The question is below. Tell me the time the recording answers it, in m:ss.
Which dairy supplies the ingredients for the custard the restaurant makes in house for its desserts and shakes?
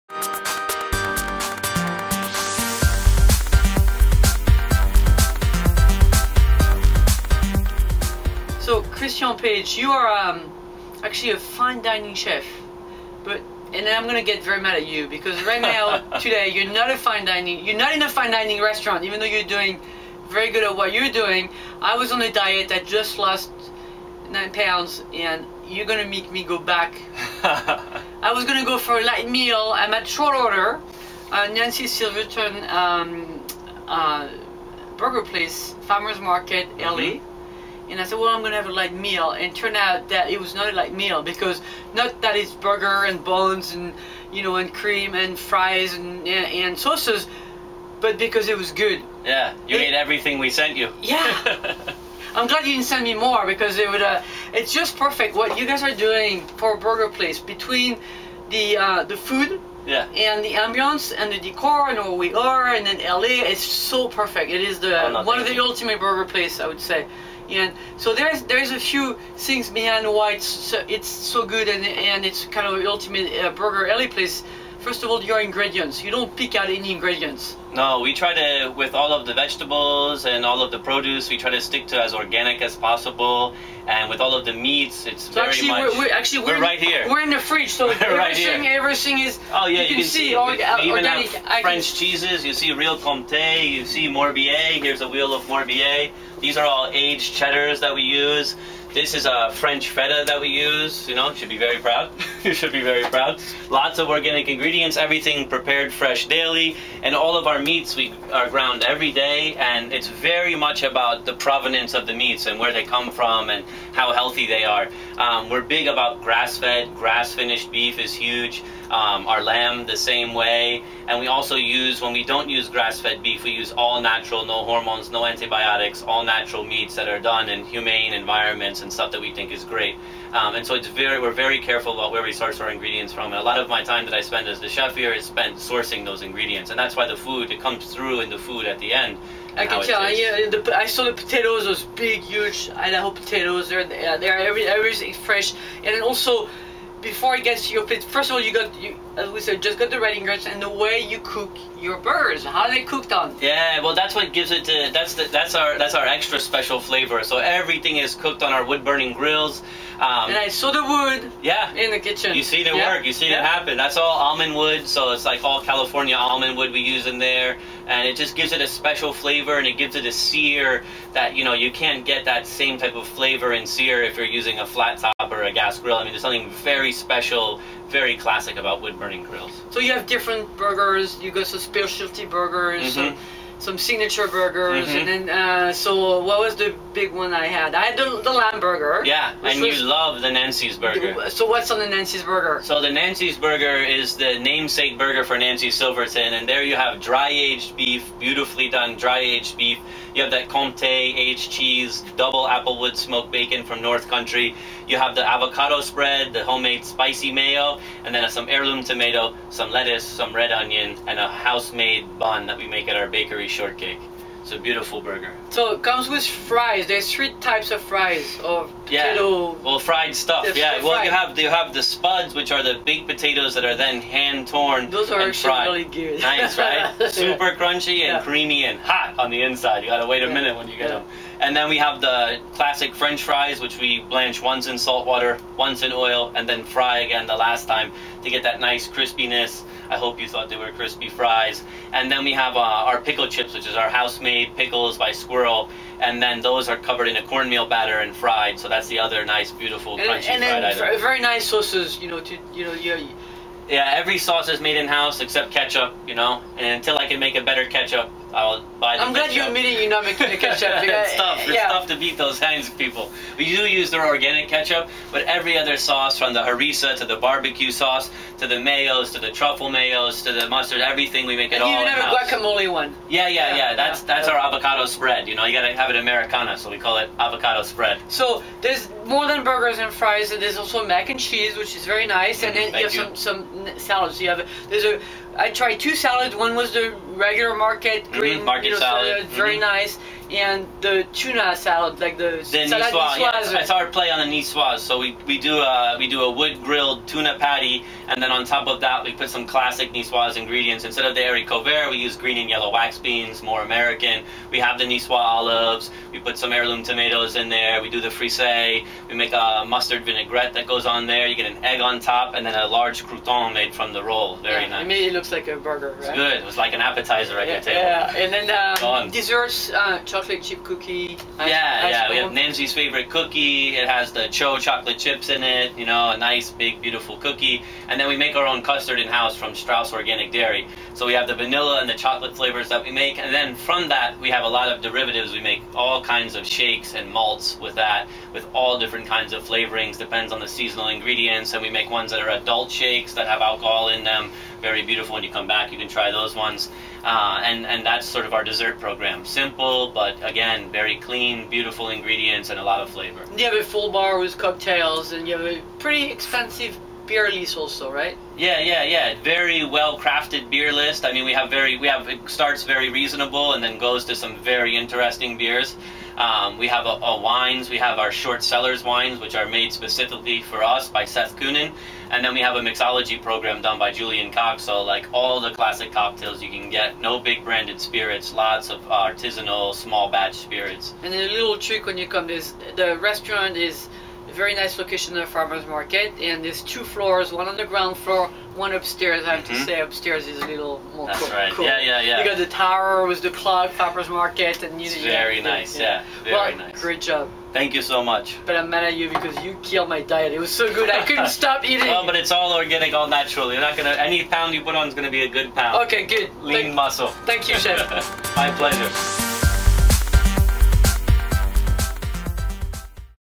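5:29.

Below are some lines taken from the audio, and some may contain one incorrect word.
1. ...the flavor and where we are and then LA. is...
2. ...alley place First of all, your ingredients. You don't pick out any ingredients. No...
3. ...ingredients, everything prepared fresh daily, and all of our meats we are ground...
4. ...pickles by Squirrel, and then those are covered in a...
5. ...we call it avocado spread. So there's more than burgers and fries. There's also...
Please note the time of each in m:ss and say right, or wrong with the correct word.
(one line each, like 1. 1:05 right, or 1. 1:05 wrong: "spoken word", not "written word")
1. 1:01 wrong: "decor", not "flavor"
2. 1:13 right
3. 1:44 right
4. 4:04 right
5. 4:36 right.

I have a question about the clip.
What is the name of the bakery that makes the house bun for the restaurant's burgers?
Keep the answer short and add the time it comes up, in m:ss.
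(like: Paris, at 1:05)
Shortcake, at 3:33.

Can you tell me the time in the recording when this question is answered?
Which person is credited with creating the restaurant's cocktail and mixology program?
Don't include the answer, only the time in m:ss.
6:13.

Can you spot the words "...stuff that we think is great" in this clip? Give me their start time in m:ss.
2:08.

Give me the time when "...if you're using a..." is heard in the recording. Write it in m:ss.
2:54.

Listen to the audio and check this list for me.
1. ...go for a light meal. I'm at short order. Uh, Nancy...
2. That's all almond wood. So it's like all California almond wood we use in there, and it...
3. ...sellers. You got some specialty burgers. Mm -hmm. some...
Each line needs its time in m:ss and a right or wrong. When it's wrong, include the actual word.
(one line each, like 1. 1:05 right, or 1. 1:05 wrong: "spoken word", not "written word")
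1. 0:28 right
2. 2:43 right
3. 3:00 wrong: "burgers", not "sellers".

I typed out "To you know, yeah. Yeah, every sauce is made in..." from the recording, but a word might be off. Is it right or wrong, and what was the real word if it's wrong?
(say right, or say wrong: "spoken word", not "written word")
right.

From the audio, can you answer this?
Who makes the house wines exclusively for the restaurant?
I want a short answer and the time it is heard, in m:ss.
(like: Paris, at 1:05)
Seth Kunin, at 6:11.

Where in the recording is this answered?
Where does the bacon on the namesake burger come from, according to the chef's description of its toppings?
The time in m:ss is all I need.
3:23.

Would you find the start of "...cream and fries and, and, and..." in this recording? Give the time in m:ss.
0:44.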